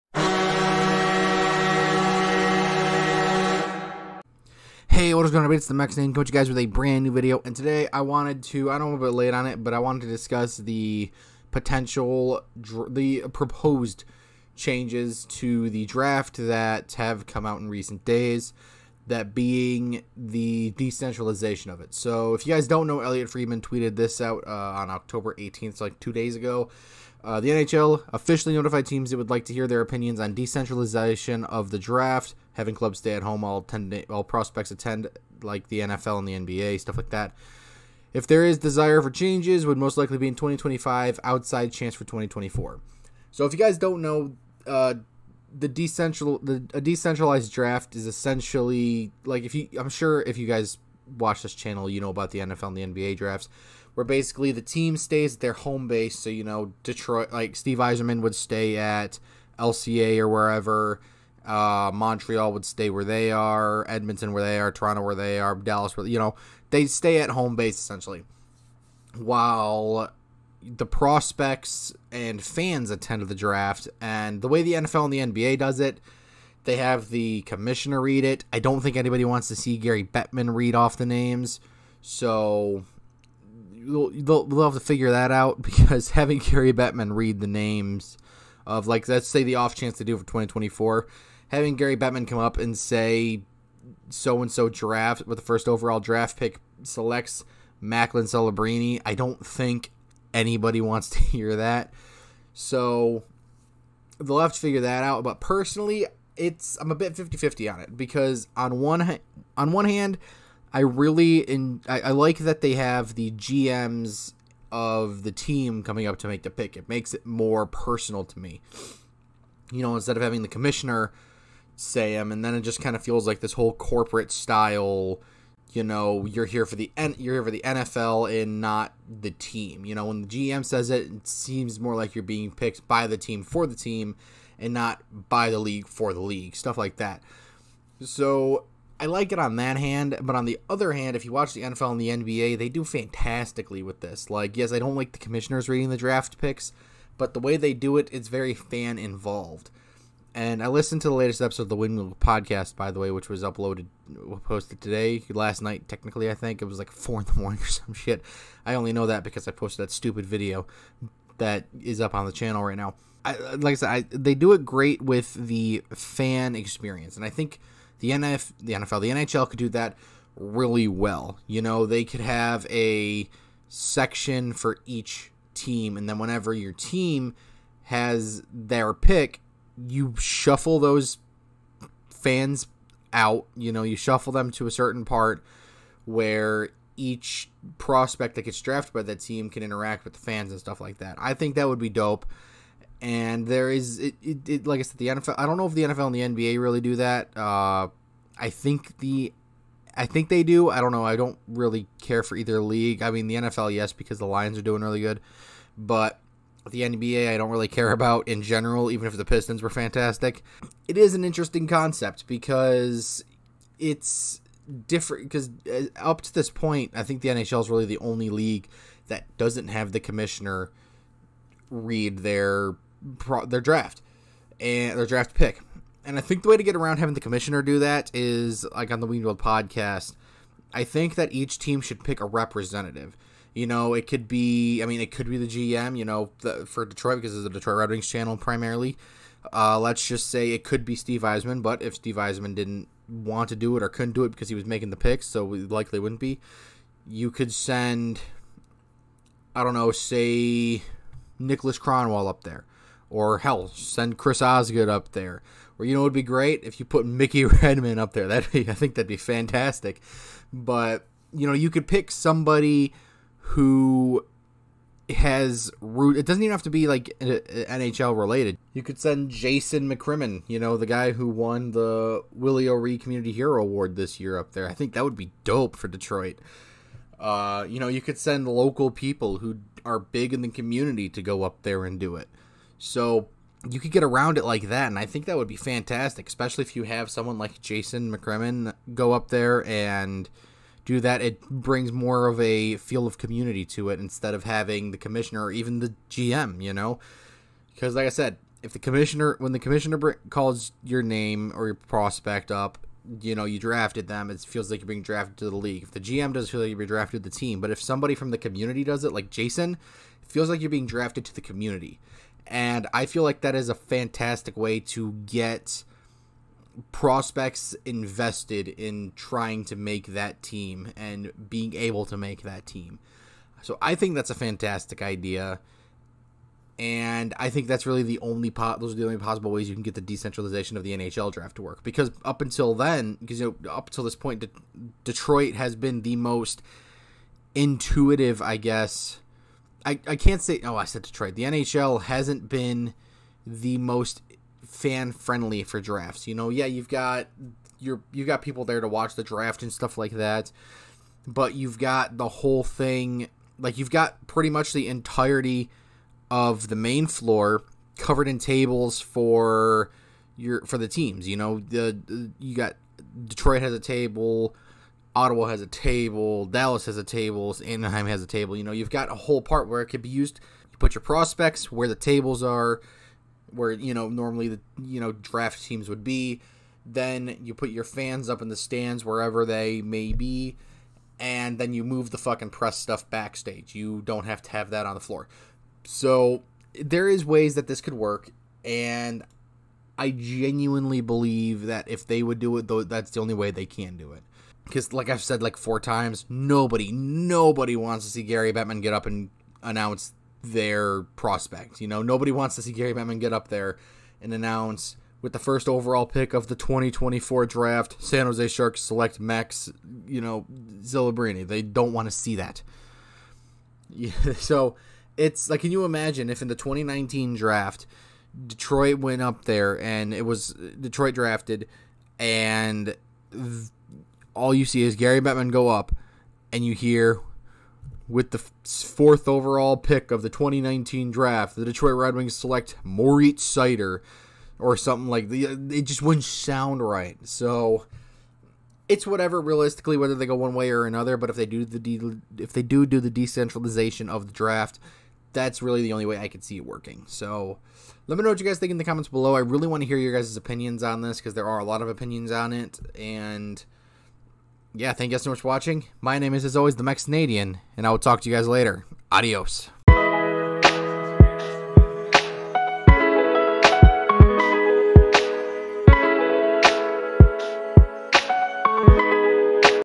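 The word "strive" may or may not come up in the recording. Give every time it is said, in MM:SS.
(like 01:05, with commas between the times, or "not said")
not said.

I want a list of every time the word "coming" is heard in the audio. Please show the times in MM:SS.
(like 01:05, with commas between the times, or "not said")
01:55.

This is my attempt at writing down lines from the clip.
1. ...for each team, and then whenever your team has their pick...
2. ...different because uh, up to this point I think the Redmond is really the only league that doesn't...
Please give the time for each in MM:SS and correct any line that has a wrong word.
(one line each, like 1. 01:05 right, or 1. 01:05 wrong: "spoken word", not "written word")
1. 02:54 right
2. 03:34 wrong: "NHL", not "Redmond".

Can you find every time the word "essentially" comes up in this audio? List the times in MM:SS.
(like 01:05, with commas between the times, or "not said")
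00:48, 01:07.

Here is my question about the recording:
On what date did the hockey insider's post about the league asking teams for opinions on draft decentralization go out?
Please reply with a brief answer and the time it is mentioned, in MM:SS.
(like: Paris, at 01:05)
October 18th, at 00:24.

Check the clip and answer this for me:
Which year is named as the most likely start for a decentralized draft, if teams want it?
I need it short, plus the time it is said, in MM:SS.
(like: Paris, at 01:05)
2025, at 00:40.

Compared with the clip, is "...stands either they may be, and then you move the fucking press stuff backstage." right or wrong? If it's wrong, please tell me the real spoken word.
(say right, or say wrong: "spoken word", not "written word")
wrong: "wherever", not "either".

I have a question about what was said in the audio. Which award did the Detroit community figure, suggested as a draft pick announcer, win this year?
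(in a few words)
Willie O'Ree Community Hero Award.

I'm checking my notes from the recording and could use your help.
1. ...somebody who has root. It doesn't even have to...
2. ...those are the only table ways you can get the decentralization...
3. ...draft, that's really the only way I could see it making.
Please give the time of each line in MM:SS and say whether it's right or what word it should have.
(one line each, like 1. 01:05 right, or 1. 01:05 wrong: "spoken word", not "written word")
1. 04:22 right
2. 05:28 wrong: "possible", not "table"
3. 07:24 wrong: "working", not "making".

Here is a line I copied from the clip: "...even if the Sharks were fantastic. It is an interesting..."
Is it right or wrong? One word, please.
wrong.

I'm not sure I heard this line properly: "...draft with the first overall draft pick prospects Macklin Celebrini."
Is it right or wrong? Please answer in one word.
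wrong.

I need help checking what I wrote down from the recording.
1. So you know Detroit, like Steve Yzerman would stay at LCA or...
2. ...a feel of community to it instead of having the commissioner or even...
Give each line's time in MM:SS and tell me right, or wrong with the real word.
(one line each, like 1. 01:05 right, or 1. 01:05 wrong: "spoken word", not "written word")
1. 00:56 right
2. 04:52 right.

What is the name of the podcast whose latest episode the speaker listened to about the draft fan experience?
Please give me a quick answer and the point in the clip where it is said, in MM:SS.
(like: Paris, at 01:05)
Windmill podcast, at 02:31.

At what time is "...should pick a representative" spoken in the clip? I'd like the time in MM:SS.
03:51.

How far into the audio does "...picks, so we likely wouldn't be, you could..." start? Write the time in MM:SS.
04:04.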